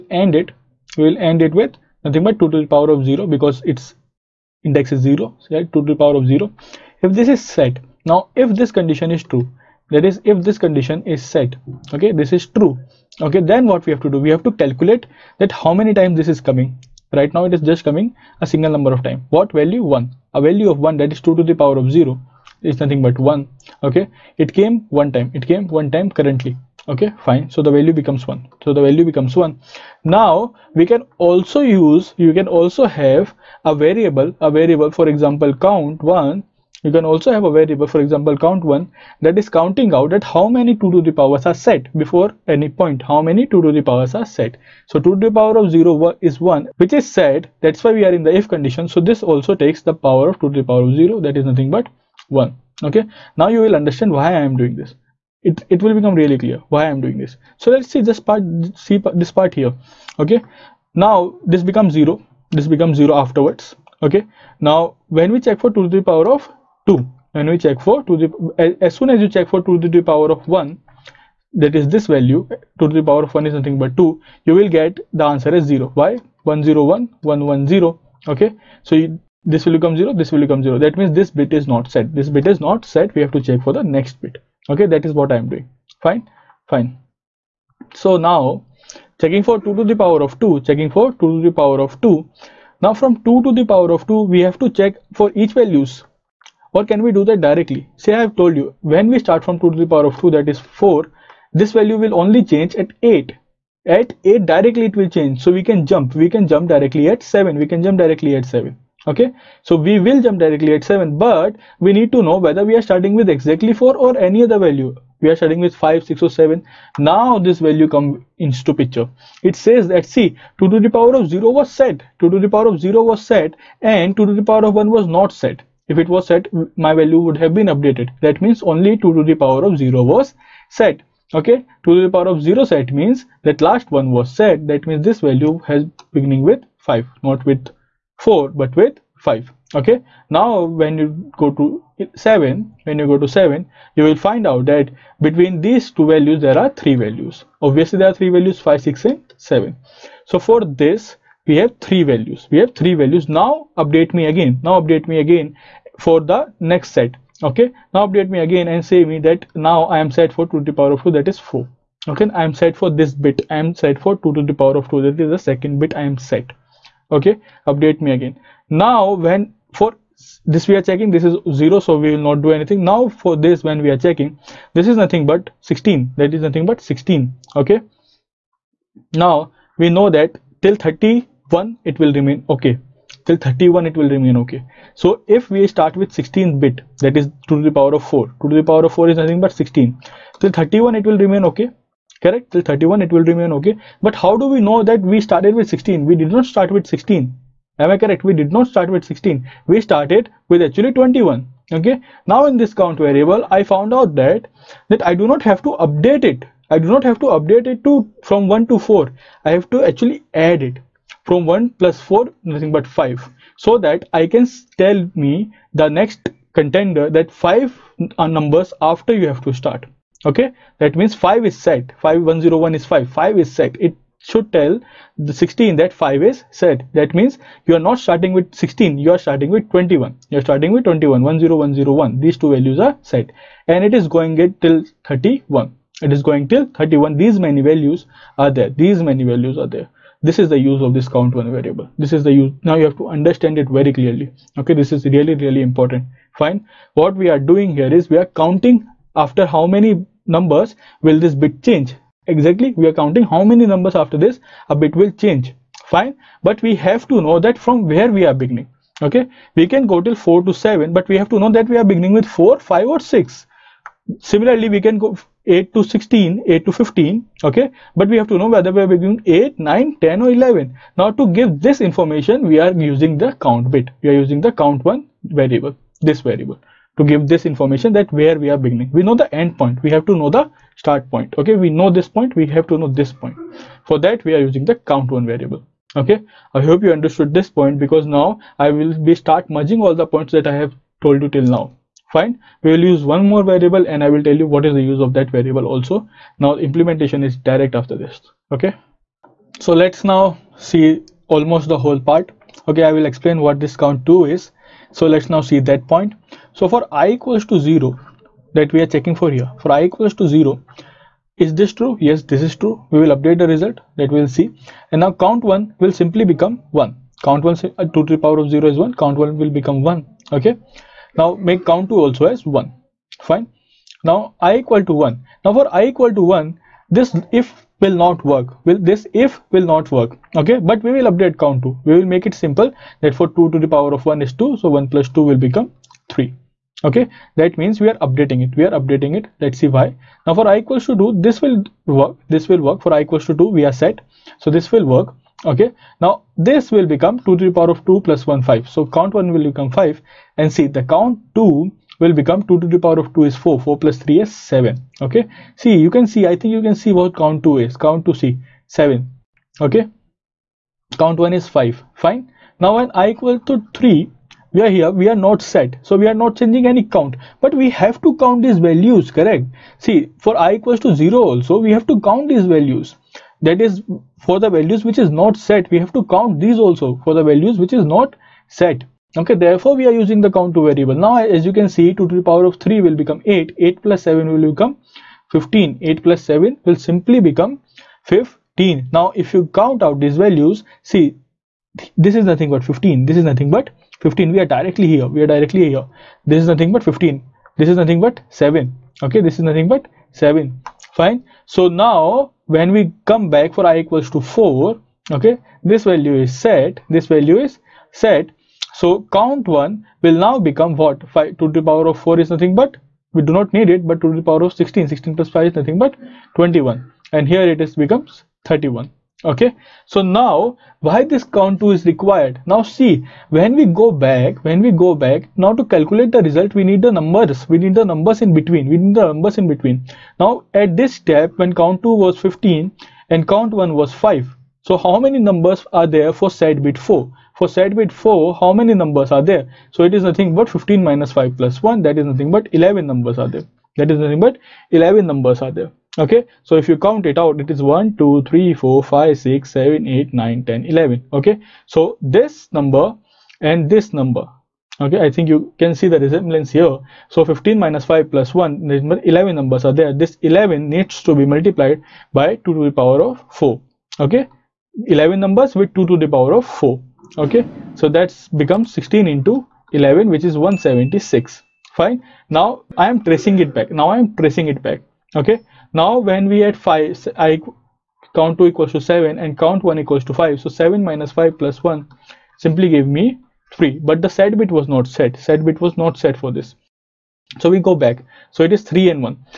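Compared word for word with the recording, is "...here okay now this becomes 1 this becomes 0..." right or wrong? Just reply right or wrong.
wrong.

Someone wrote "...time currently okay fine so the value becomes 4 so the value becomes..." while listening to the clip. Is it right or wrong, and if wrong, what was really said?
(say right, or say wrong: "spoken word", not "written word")
wrong: "1", not "4".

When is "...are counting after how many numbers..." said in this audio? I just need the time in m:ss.
4:08.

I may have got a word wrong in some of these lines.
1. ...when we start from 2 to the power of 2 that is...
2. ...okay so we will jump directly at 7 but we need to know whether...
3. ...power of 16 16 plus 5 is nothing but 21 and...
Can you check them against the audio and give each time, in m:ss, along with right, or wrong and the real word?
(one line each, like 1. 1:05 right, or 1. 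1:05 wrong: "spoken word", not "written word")
1. 1:38 right
2. 1:49 right
3. 6:54 right.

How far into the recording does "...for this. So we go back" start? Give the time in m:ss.
8:06.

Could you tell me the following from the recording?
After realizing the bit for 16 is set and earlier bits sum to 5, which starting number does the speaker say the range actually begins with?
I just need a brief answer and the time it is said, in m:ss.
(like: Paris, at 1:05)
21, at 3:19.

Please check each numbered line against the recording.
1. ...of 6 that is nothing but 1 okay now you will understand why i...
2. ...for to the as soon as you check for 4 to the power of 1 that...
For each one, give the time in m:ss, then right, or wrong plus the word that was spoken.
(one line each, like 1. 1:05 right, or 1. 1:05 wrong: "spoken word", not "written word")
1. 0:50 wrong: "0", not "6"
2. 1:07 wrong: "2", not "4".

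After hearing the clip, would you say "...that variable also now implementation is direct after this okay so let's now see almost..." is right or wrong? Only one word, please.
right.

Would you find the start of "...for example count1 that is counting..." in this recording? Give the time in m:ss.
0:37.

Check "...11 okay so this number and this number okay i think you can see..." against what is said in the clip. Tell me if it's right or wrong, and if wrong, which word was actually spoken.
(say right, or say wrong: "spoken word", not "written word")
right.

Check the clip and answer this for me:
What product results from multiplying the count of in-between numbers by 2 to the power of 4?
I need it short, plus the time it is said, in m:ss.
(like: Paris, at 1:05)
176, at 7:50.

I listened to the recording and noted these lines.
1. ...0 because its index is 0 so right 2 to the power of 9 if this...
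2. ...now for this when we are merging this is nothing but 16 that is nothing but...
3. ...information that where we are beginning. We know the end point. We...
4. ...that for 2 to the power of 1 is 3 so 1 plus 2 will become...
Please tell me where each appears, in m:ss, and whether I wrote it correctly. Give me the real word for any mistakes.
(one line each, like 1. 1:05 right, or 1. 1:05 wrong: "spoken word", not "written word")
1. 0:03 wrong: "0", not "9"
2. 2:52 wrong: "checking", not "merging"
3. 4:37 right
4. 5:33 wrong: "2", not "3".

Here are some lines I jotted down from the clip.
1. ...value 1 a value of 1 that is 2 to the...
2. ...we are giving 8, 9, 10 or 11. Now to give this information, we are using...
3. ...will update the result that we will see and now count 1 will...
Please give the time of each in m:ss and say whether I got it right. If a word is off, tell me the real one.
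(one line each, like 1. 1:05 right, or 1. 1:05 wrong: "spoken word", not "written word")
1. 0:19 right
2. 4:28 right
3. 5:13 right.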